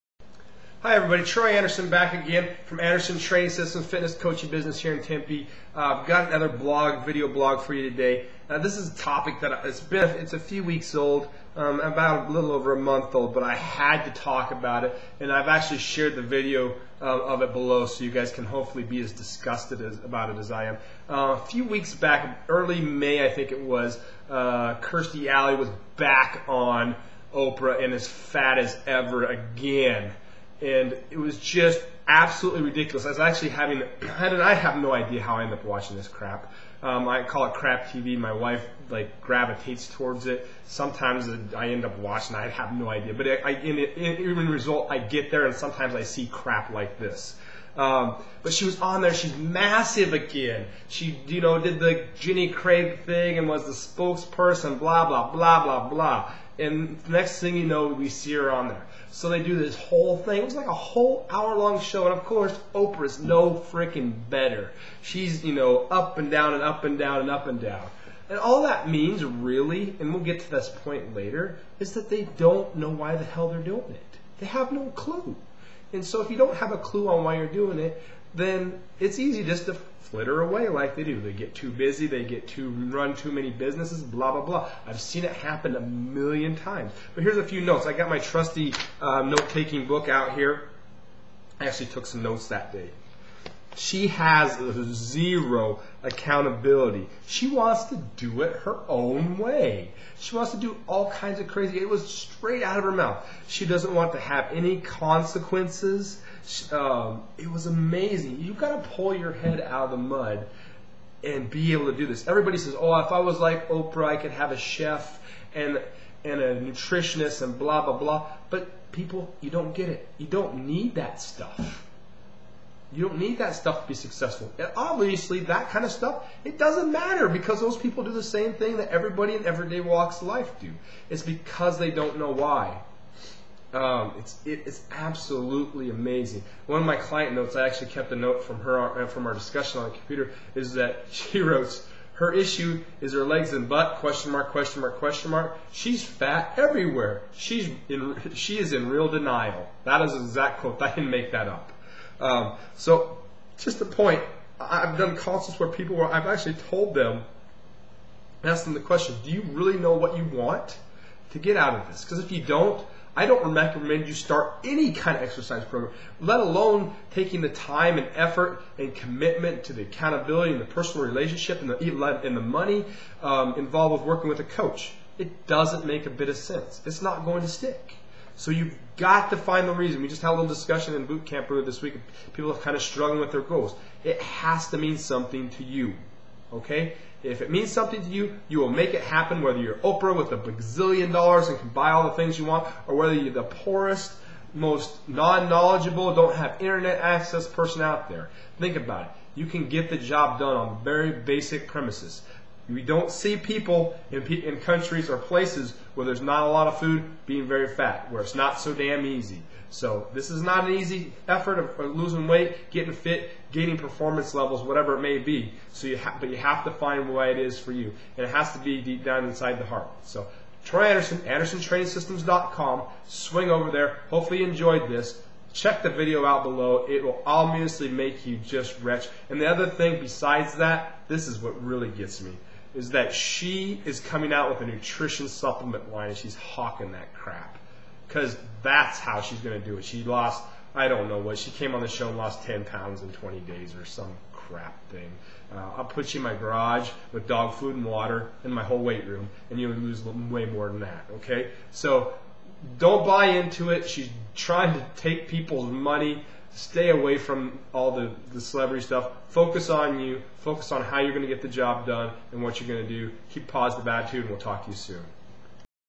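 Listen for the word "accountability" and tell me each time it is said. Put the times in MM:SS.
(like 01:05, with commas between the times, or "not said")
01:36, 02:49.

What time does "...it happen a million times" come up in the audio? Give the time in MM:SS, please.
01:25.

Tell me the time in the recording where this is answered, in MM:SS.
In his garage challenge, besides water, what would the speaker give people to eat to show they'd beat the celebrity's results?
04:07.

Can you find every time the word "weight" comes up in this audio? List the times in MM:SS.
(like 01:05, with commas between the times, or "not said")
03:32, 04:08.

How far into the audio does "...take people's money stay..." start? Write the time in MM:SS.
04:14.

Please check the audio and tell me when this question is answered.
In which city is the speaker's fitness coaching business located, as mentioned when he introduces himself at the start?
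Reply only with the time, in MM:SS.
00:05.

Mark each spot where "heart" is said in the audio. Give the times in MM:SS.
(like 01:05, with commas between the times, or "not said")
03:39.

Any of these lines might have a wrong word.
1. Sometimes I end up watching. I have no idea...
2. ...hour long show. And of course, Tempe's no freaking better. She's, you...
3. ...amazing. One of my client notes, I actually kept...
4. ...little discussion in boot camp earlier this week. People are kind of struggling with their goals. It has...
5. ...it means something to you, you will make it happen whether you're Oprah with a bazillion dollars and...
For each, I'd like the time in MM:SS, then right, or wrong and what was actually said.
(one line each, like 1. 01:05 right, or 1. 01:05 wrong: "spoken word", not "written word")
1. 00:40 right
2. 01:01 wrong: "Oprah", not "Tempe"
3. 02:15 right
4. 03:00 right
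5. 03:07 right.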